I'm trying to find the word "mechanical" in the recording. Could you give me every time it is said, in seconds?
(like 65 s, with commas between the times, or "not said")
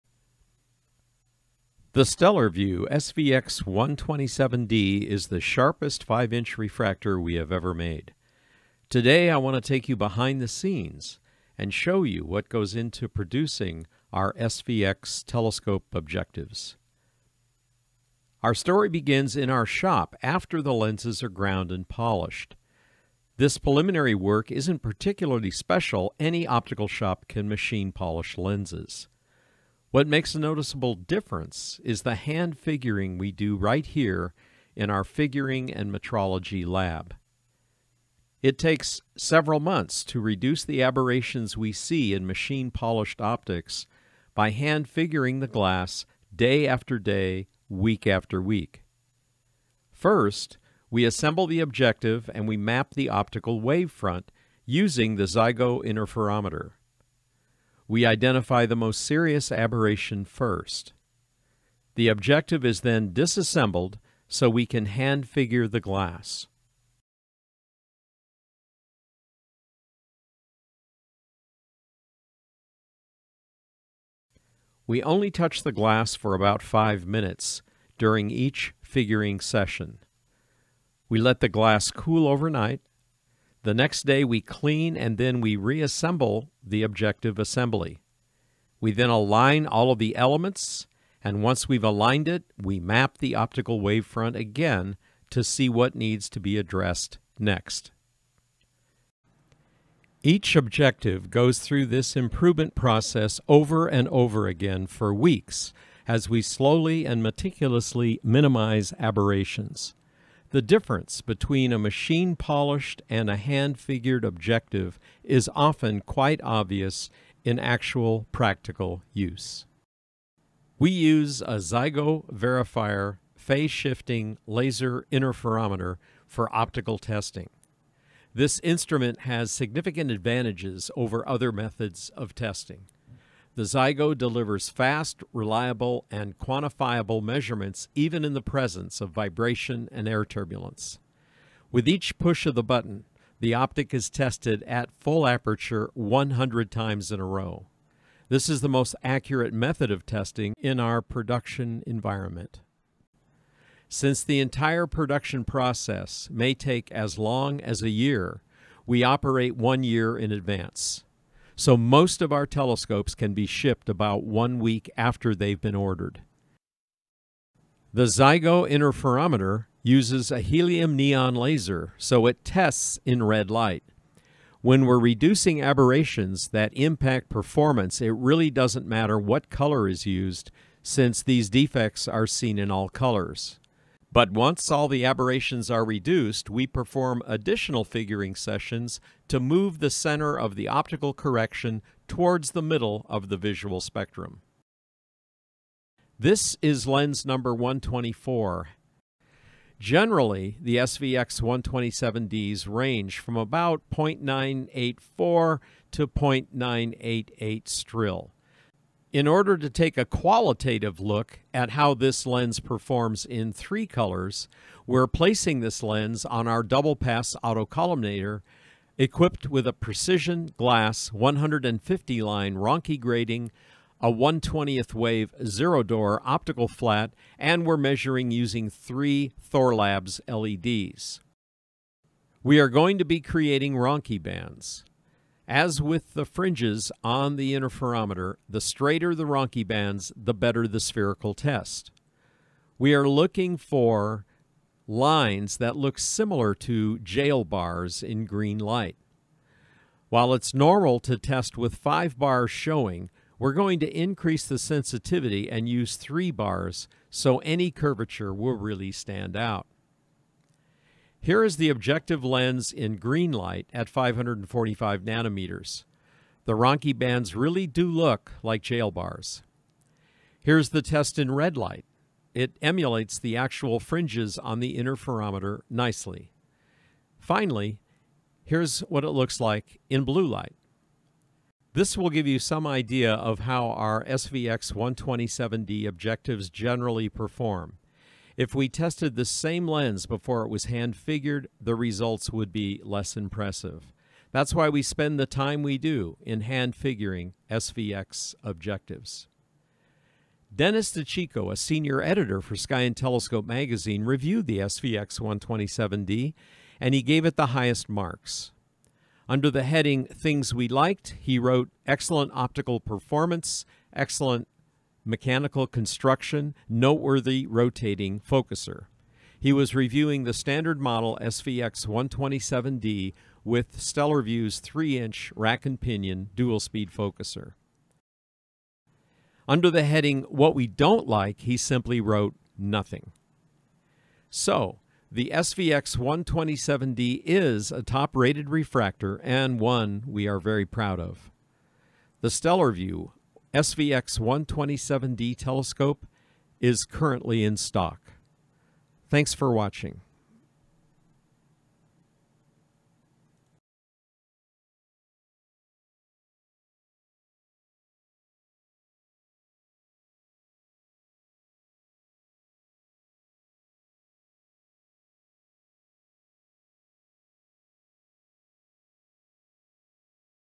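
315 s.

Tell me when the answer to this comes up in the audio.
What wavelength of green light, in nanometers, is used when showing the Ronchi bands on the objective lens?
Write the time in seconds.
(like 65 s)
263 s.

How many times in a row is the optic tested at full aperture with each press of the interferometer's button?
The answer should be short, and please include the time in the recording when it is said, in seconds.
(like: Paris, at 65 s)
100, at 145 s.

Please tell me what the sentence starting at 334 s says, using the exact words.
So, the SVX 127D is a top-rated refractor and one we are very proud of.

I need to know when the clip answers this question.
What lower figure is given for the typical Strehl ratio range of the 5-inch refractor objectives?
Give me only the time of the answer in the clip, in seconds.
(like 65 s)
203 s.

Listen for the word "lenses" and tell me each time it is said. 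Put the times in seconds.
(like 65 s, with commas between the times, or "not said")
20 s, 28 s.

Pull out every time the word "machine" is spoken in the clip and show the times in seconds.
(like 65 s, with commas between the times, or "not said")
27 s, 42 s, 111 s.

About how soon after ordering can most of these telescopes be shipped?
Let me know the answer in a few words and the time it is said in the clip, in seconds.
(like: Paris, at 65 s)
1 week, at 164 s.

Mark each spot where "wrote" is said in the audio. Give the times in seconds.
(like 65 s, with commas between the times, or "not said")
311 s, 331 s.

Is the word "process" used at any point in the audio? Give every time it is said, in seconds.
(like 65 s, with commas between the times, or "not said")
102 s, 155 s.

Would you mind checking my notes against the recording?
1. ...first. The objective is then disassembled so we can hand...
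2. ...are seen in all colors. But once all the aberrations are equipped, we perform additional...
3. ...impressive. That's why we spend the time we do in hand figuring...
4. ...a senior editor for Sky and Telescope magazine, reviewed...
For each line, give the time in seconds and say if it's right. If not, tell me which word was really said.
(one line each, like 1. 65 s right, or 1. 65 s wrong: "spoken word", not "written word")
1. 60 s right
2. 182 s wrong: "reduced", not "equipped"
3. 293 s right
4. 301 s right.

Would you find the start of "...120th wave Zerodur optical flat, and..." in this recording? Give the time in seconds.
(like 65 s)
224 s.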